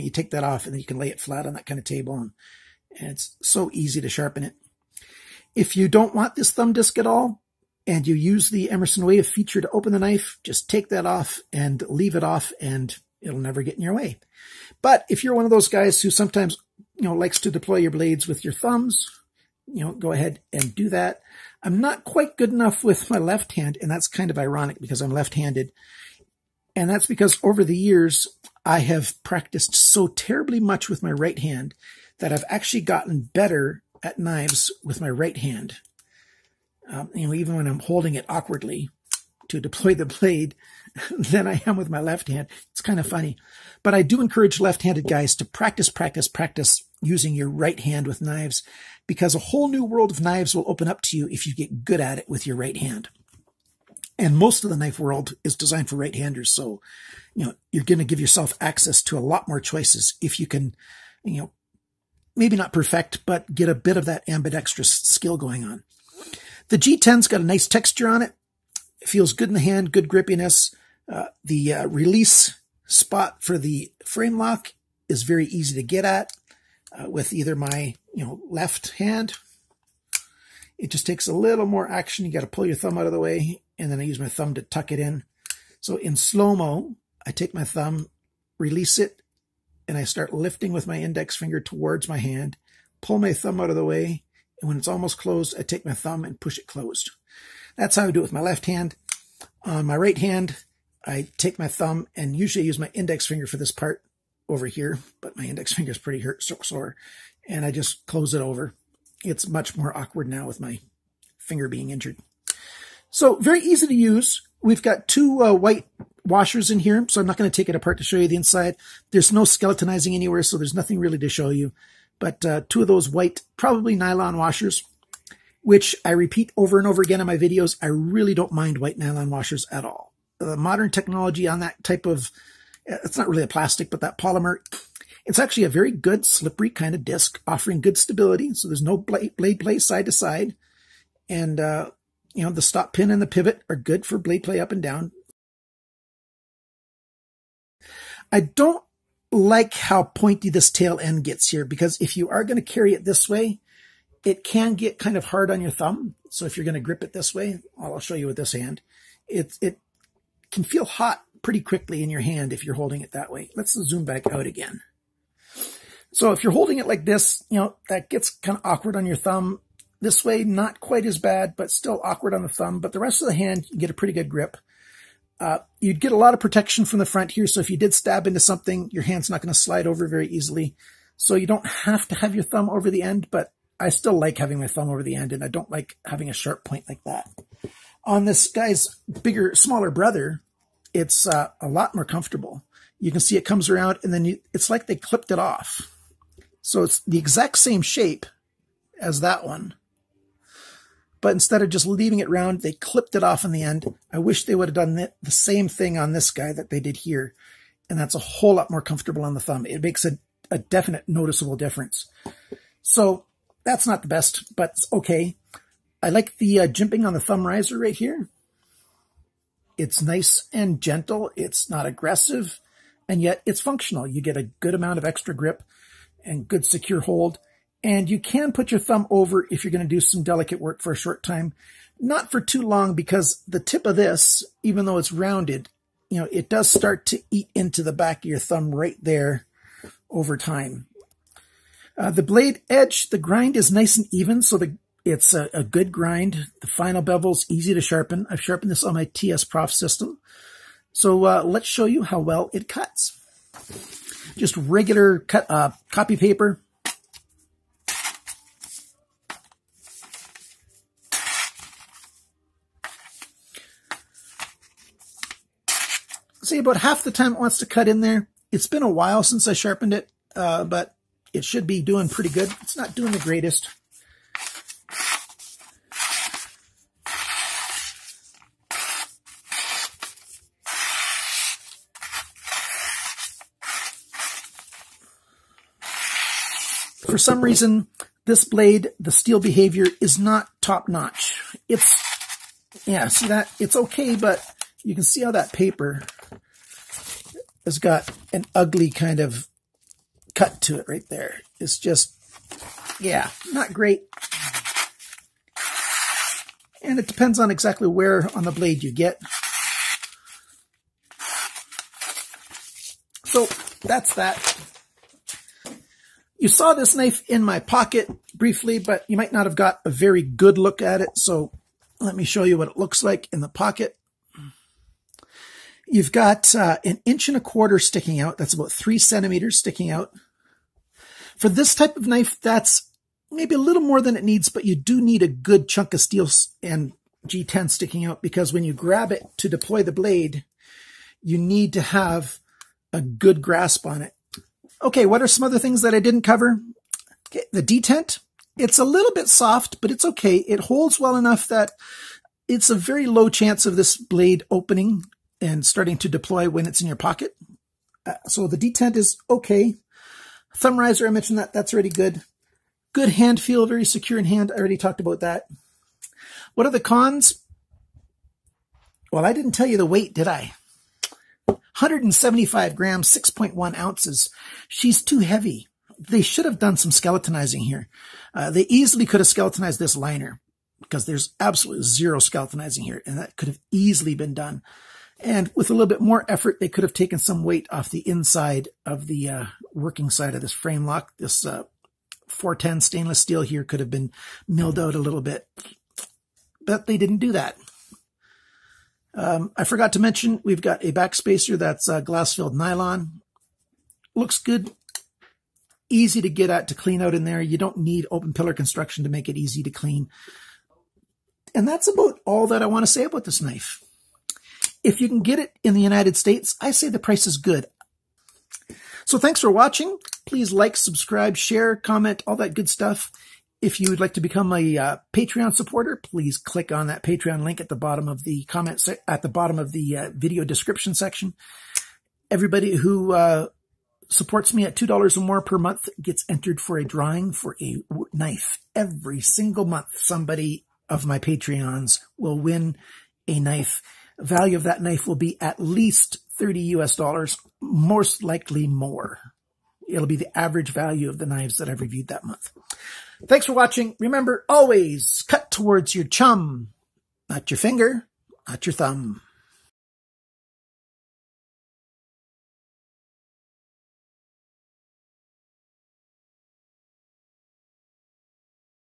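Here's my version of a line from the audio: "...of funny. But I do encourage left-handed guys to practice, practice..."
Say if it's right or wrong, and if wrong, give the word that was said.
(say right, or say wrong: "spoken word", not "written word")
right.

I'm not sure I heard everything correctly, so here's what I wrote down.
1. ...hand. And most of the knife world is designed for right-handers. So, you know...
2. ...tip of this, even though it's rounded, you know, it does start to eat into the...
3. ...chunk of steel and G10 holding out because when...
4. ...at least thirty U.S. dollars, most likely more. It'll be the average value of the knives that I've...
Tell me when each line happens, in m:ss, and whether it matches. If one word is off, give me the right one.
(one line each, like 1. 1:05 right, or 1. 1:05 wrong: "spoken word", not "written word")
1. 0:52 right
2. 3:53 right
3. 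5:35 wrong: "sticking", not "holding"
4. 7:25 right.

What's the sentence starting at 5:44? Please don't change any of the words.
Okay, what are some other things that I didn't cover?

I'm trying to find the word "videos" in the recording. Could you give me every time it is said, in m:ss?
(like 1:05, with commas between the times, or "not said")
2:07, 7:10.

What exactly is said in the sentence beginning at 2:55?
Uh, you'd get a lot of protection from the front here.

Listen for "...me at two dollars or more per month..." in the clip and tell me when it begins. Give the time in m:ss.
7:14.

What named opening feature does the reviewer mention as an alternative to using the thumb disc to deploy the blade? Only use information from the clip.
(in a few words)
Emerson Wave.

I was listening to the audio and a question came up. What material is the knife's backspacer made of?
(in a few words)
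Glass filled nylon.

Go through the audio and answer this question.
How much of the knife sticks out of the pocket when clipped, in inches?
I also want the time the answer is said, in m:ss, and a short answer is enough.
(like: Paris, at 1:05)
1.25 inches, at 5:26.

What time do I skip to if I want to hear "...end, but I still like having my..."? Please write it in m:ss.
3:03.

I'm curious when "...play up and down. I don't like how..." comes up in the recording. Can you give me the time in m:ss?
2:24.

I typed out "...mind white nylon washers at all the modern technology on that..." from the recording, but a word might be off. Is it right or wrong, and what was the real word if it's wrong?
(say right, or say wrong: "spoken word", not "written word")
right.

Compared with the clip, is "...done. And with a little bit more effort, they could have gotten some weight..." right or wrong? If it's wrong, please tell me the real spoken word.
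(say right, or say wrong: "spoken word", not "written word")
wrong: "taken", not "gotten".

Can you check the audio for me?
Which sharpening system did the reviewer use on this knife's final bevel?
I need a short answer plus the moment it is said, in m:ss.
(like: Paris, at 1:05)
TS Prof, at 4:09.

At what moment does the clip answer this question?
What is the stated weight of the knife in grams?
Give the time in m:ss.
6:11.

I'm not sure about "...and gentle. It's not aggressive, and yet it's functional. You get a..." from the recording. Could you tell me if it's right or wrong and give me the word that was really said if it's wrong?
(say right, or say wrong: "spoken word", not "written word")
right.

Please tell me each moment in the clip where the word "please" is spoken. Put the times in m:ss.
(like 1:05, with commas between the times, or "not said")
7:00, 7:05.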